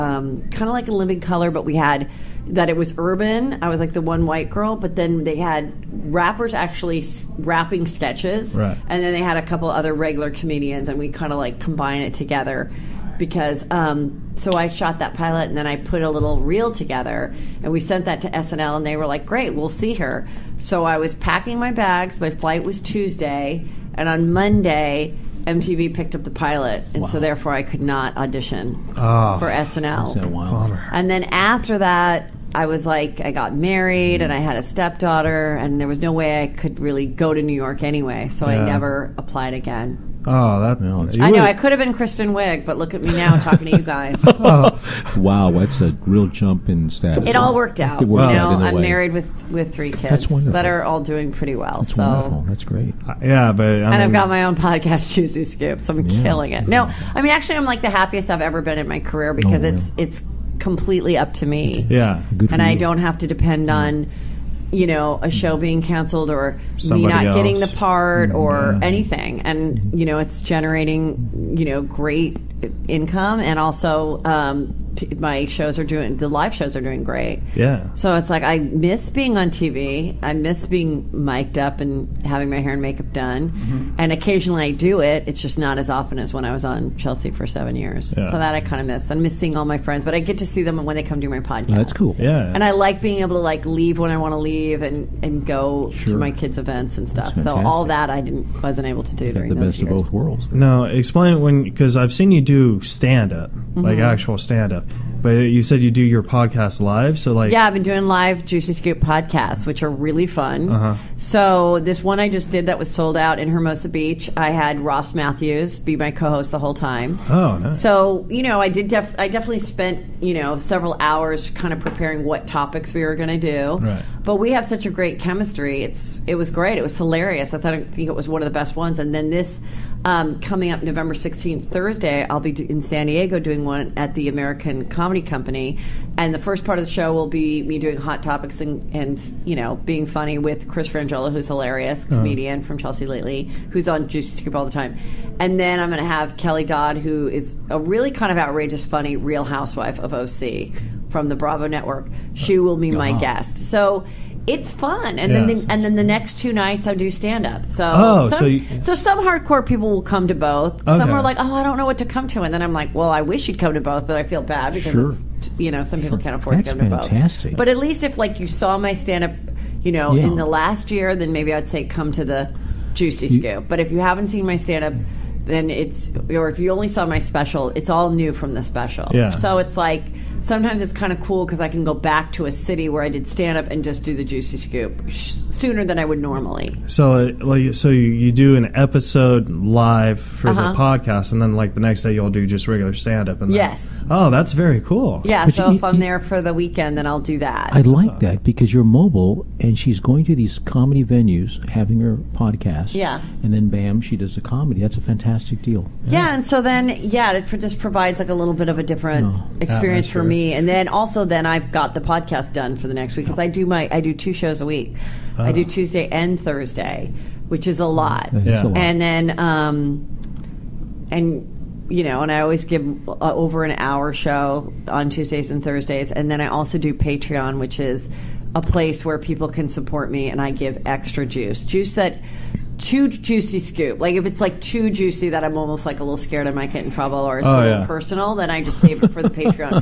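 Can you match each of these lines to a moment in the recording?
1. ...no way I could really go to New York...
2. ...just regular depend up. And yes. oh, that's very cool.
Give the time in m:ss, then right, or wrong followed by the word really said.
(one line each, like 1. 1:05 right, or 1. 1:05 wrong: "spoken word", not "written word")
1. 0:35 right
2. 3:12 wrong: "stand", not "depend".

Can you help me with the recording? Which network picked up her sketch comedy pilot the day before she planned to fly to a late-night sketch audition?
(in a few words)
MTV.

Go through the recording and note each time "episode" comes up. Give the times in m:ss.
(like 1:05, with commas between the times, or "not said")
3:08.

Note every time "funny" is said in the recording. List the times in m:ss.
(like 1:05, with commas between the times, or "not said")
2:20, 2:28.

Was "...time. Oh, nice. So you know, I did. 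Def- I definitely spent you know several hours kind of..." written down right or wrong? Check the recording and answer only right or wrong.
right.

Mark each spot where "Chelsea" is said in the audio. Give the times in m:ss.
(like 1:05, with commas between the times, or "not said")
1:26, 2:22.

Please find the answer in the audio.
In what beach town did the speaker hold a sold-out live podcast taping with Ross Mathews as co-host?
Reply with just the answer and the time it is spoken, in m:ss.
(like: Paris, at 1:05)
Hermosa Beach, at 1:53.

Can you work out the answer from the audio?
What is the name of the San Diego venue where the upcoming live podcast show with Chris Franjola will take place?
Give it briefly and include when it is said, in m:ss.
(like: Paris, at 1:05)
American Comedy Company, at 2:14.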